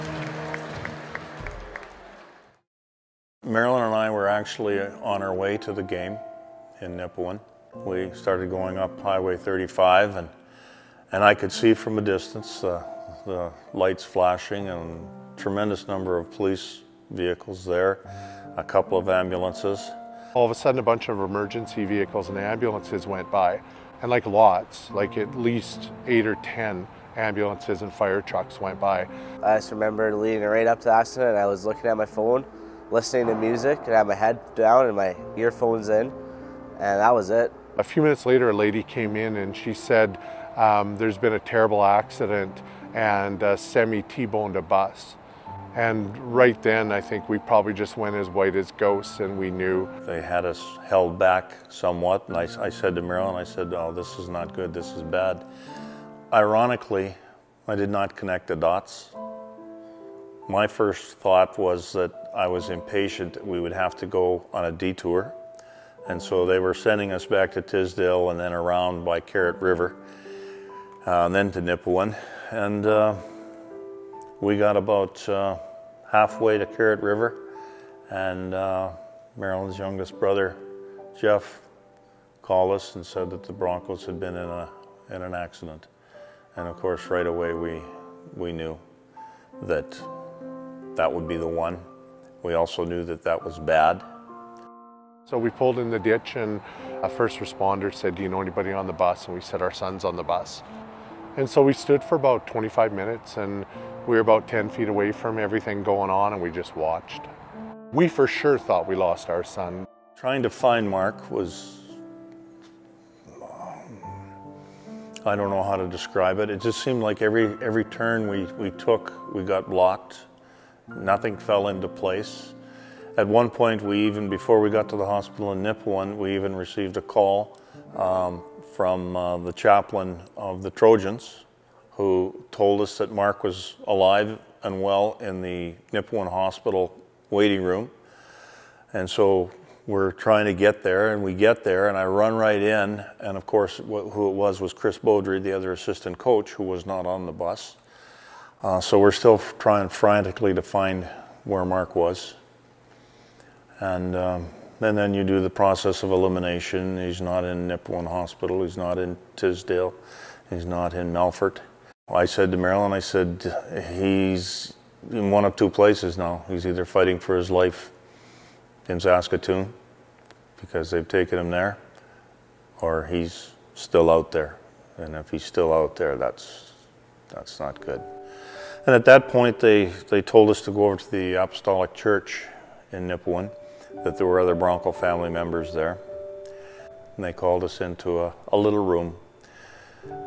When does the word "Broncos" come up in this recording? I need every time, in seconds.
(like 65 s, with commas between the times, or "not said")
83 s, 184 s.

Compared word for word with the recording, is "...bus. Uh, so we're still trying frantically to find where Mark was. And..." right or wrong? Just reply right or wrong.
right.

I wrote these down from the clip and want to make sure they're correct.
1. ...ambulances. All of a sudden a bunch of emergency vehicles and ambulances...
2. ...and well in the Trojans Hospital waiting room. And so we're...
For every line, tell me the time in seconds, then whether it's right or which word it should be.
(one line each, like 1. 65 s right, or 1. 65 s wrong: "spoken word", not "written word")
1. 19 s right
2. 134 s wrong: "Nipawin", not "Trojans".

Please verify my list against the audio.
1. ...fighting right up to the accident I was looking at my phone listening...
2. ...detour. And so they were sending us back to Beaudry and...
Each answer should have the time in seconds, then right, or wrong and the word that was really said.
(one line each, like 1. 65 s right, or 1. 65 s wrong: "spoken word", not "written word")
1. 30 s wrong: "leading", not "fighting"
2. 64 s wrong: "Tisdale", not "Beaudry".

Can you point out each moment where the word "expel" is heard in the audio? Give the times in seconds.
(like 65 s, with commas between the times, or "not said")
not said.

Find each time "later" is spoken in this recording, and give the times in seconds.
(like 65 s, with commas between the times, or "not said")
38 s.